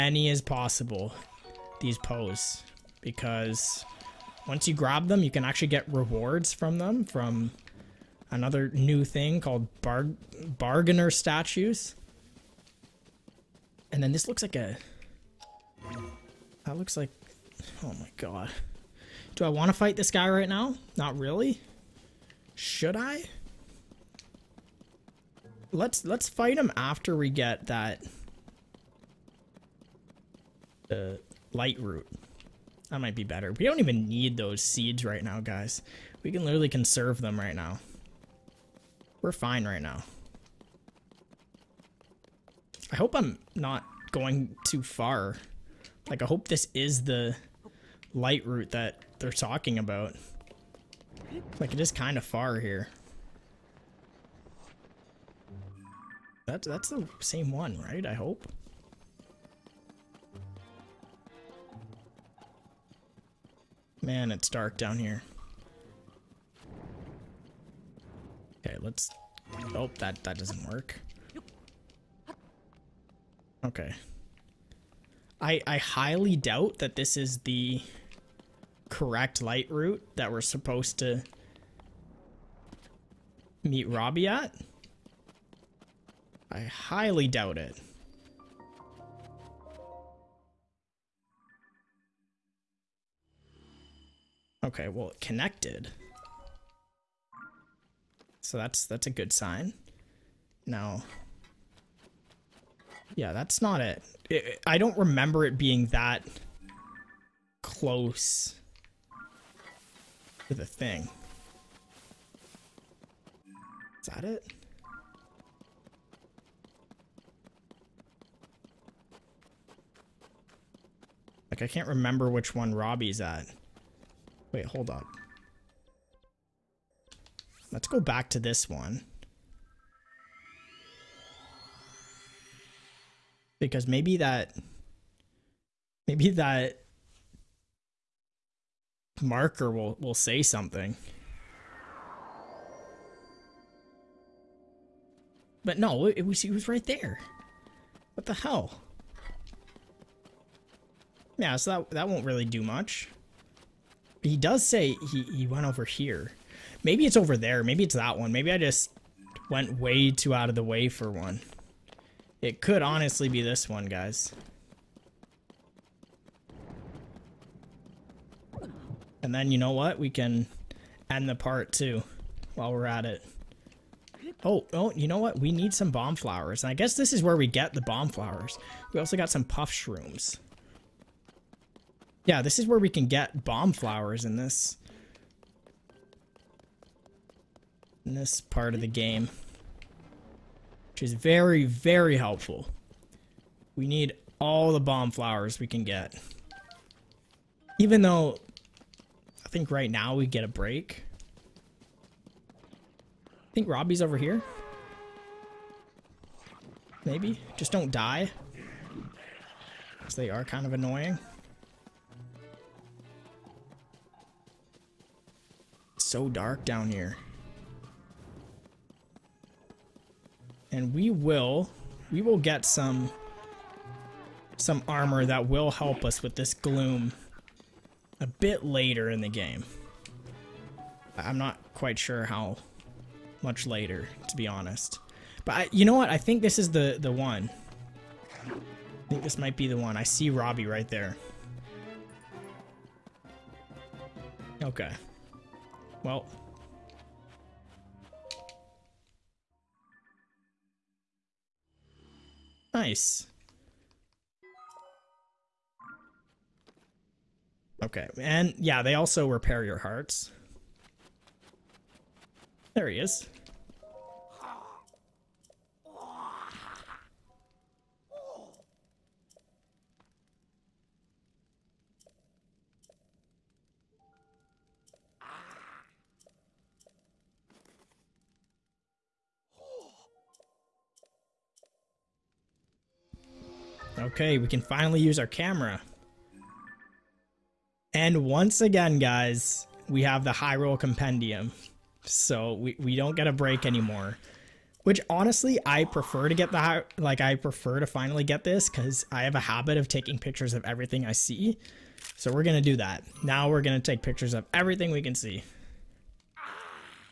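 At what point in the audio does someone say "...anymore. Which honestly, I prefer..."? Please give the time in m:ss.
4:53.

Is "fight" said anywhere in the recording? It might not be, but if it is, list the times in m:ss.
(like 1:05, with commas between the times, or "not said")
0:19, 0:26.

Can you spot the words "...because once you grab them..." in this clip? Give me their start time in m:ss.
0:02.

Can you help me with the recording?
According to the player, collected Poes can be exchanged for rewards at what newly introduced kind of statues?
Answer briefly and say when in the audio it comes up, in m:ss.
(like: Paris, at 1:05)
Bargainer statues, at 0:09.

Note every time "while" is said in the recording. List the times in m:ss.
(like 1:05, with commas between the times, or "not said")
2:52.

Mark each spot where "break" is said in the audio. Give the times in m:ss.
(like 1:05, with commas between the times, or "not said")
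3:20, 4:53.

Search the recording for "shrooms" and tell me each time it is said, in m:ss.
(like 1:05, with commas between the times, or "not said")
2:59.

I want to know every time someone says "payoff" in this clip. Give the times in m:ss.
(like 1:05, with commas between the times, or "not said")
not said.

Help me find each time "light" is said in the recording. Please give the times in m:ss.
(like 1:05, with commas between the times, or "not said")
0:31, 0:48, 1:19.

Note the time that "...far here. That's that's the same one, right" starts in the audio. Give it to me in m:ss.
0:52.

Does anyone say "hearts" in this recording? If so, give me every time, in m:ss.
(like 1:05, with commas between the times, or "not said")
4:19.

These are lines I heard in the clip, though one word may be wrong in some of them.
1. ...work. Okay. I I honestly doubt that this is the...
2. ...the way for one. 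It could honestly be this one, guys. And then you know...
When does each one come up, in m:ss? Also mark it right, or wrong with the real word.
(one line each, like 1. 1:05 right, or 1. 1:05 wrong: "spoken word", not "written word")
1. 1:10 wrong: "highly", not "honestly"
2. 2:40 right.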